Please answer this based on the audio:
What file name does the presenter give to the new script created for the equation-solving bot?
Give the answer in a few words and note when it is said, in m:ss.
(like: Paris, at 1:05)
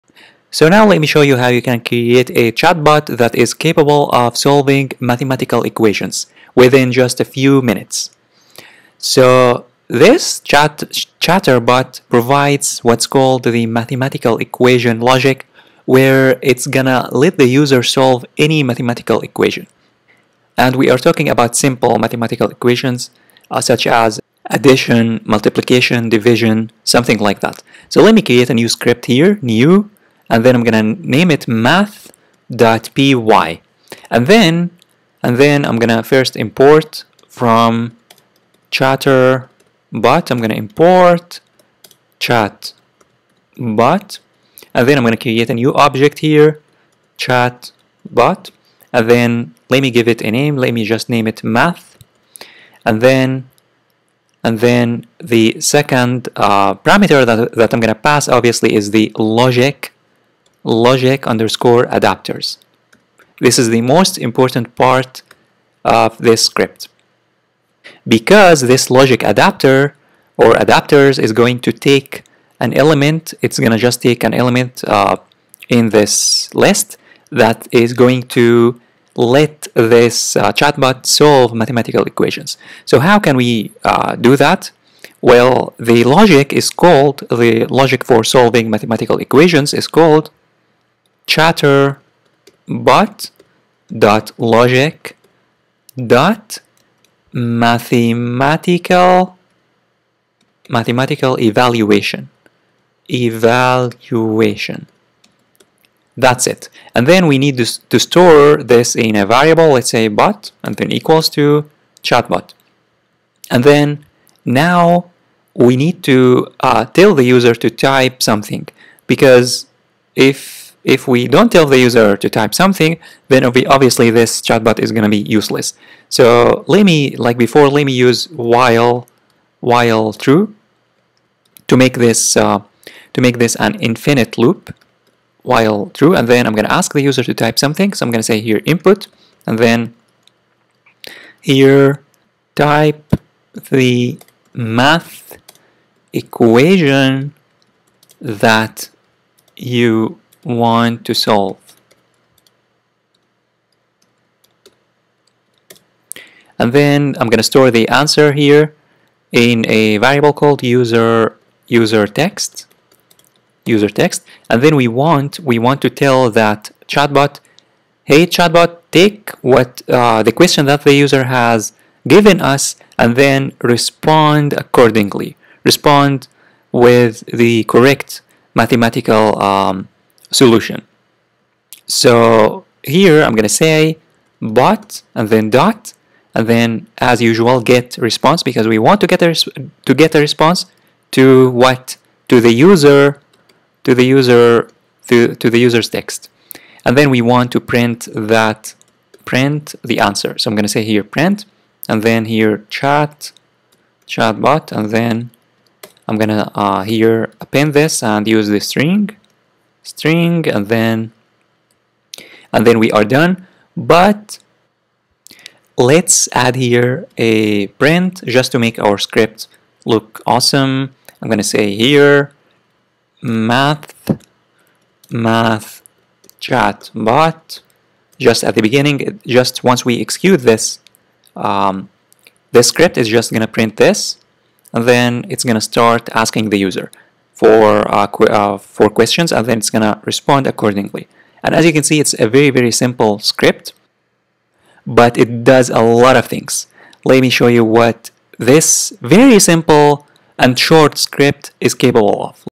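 math.py, at 0:31.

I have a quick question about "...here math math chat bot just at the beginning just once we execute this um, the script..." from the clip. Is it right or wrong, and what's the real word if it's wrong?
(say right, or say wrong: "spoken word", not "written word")
right.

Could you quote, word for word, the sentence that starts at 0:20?
And we are talking about simple mathematical equations uh, such as addition, multiplication, division, something like that.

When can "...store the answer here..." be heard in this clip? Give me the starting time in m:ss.
2:37.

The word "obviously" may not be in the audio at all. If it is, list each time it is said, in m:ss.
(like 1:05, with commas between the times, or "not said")
0:58, 2:03.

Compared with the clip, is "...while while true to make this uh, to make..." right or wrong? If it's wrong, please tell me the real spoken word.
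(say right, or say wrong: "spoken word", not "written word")
right.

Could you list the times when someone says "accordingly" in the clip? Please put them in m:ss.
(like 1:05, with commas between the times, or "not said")
2:54, 4:00.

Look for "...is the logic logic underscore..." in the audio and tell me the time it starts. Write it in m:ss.
0:58.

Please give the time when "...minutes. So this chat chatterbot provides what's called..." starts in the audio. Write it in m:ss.
0:07.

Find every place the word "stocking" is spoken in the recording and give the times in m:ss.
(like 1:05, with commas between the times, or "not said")
not said.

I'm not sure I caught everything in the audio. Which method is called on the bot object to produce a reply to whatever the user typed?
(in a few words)
get response.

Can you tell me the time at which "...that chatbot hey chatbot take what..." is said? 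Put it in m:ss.
2:46.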